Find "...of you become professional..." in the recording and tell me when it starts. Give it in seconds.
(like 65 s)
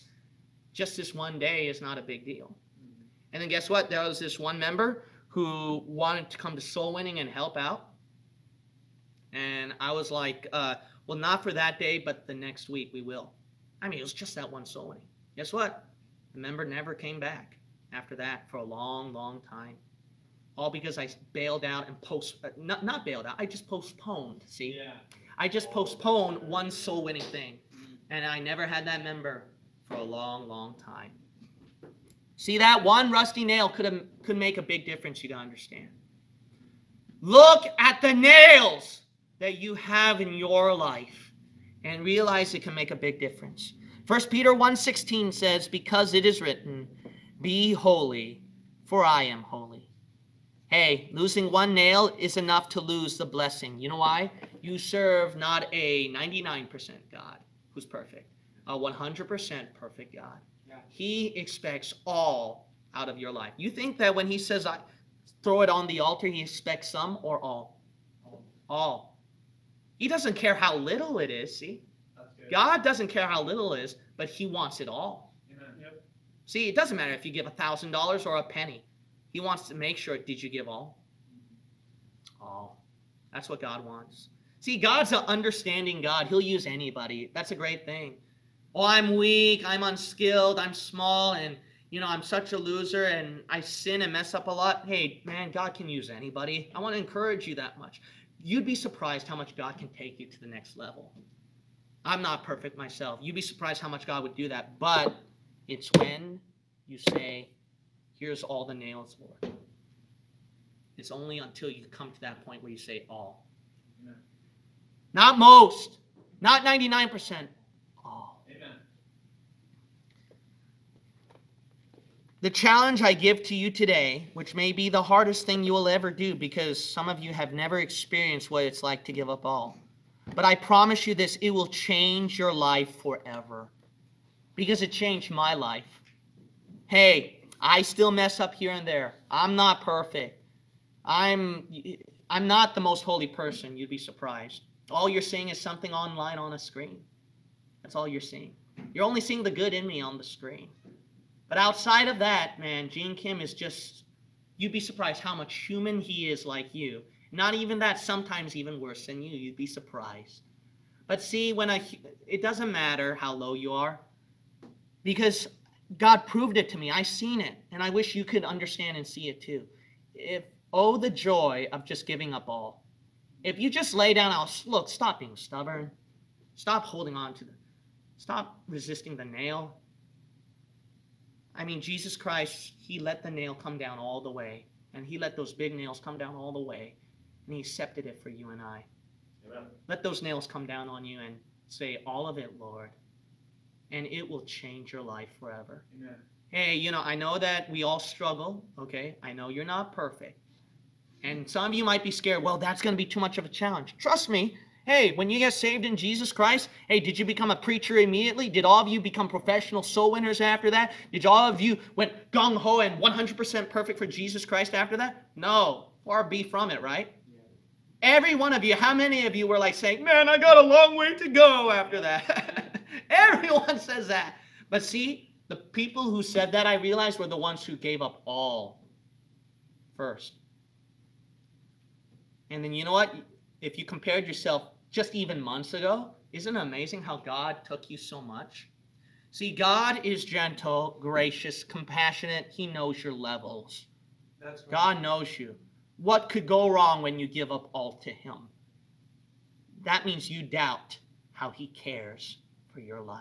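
208 s.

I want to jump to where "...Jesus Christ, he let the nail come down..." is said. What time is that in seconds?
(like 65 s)
181 s.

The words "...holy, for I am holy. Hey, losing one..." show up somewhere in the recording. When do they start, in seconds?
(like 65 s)
47 s.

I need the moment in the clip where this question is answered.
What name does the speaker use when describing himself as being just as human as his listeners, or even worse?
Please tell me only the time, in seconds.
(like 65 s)
152 s.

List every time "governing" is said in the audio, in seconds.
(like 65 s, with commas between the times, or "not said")
not said.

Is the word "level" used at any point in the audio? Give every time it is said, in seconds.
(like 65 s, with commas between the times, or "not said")
100 s, 243 s.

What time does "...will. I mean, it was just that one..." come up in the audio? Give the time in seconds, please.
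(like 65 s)
13 s.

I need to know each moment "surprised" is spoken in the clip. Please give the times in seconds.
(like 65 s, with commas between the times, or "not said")
98 s, 103 s, 143 s, 154 s, 159 s.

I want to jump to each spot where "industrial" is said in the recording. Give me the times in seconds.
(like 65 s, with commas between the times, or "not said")
not said.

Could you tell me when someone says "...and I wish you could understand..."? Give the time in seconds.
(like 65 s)
167 s.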